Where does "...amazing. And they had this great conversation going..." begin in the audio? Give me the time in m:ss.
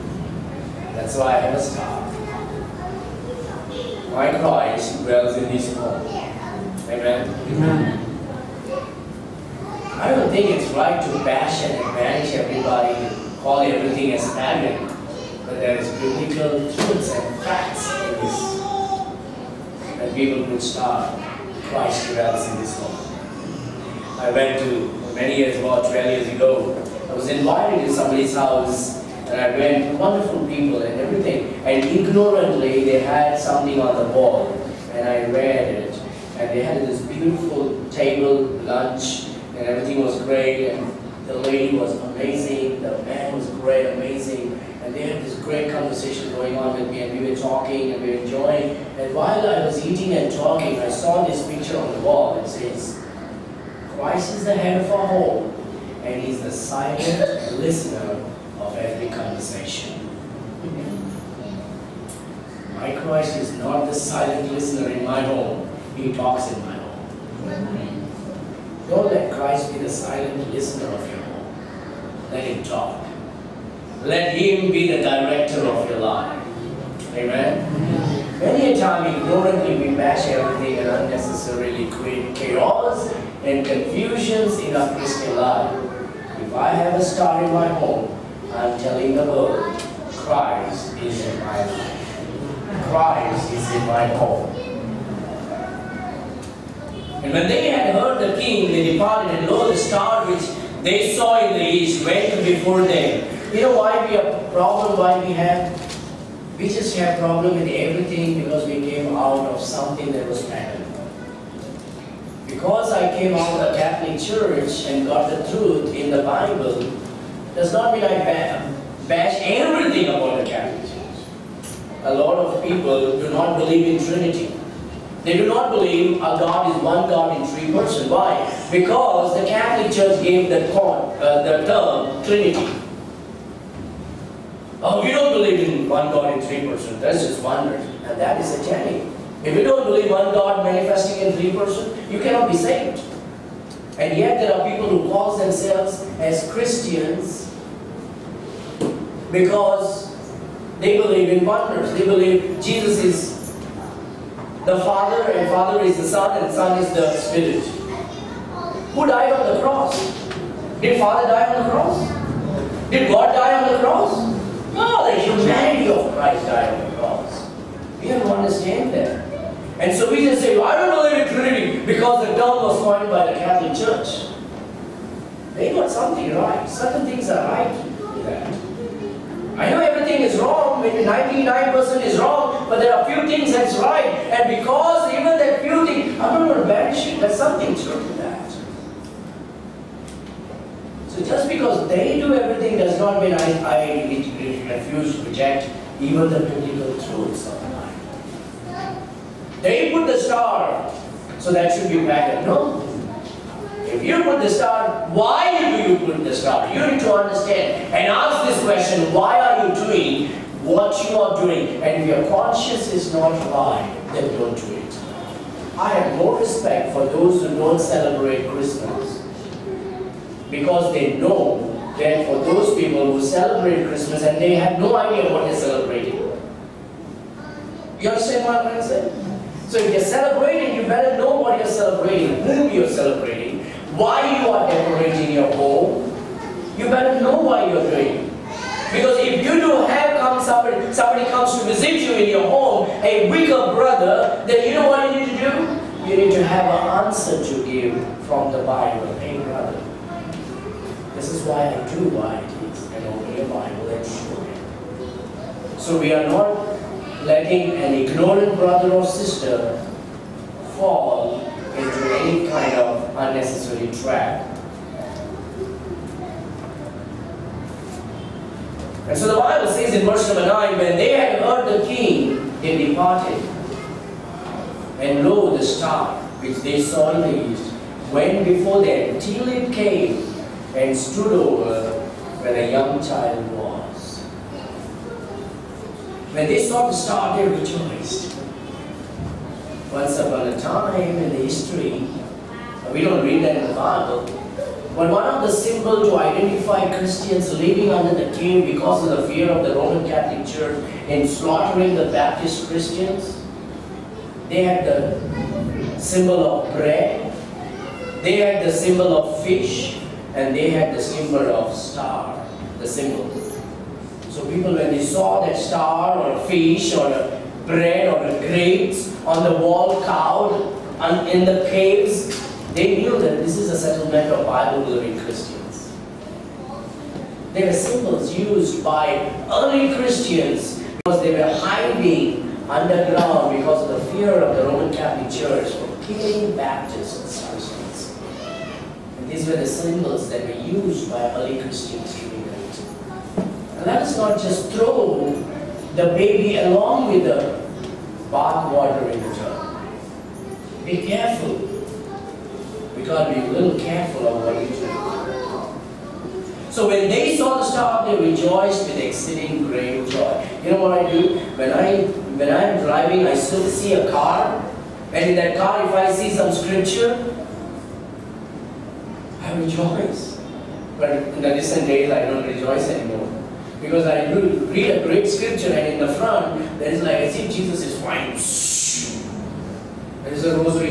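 0:43.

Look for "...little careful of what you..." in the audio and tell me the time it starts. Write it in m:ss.
5:53.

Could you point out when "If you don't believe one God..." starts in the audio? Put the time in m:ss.
2:19.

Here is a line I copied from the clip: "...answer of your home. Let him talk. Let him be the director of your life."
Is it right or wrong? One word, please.
wrong.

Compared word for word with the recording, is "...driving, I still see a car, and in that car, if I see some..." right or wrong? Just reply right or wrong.
right.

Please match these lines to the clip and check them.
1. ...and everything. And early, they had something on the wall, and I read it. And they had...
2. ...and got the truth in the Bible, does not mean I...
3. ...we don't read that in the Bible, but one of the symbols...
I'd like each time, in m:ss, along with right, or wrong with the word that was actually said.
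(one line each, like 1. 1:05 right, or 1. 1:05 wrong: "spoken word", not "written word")
1. 0:30 wrong: "ignorantly", not "early"
2. 1:54 right
3. 4:52 right.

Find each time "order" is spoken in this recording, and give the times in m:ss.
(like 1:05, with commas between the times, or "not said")
not said.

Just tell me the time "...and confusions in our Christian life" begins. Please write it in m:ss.
1:23.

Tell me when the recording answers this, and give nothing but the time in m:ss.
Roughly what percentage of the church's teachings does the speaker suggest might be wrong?
3:01.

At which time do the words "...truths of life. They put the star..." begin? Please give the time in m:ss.
3:16.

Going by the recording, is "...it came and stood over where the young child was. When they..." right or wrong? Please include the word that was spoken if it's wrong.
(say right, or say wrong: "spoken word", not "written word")
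right.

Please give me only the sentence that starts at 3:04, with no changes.
And because even that few things, I'm not going to banish it.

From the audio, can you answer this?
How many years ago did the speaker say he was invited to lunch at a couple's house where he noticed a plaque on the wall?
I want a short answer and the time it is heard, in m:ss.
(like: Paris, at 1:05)
12, at 0:25.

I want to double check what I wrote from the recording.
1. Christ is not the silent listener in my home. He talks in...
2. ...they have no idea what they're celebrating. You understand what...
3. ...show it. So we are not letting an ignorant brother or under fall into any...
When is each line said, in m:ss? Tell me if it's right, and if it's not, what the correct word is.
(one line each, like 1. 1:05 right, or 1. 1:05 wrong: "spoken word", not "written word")
1. 1:03 right
2. 3:44 right
3. 4:14 wrong: "sister", not "under".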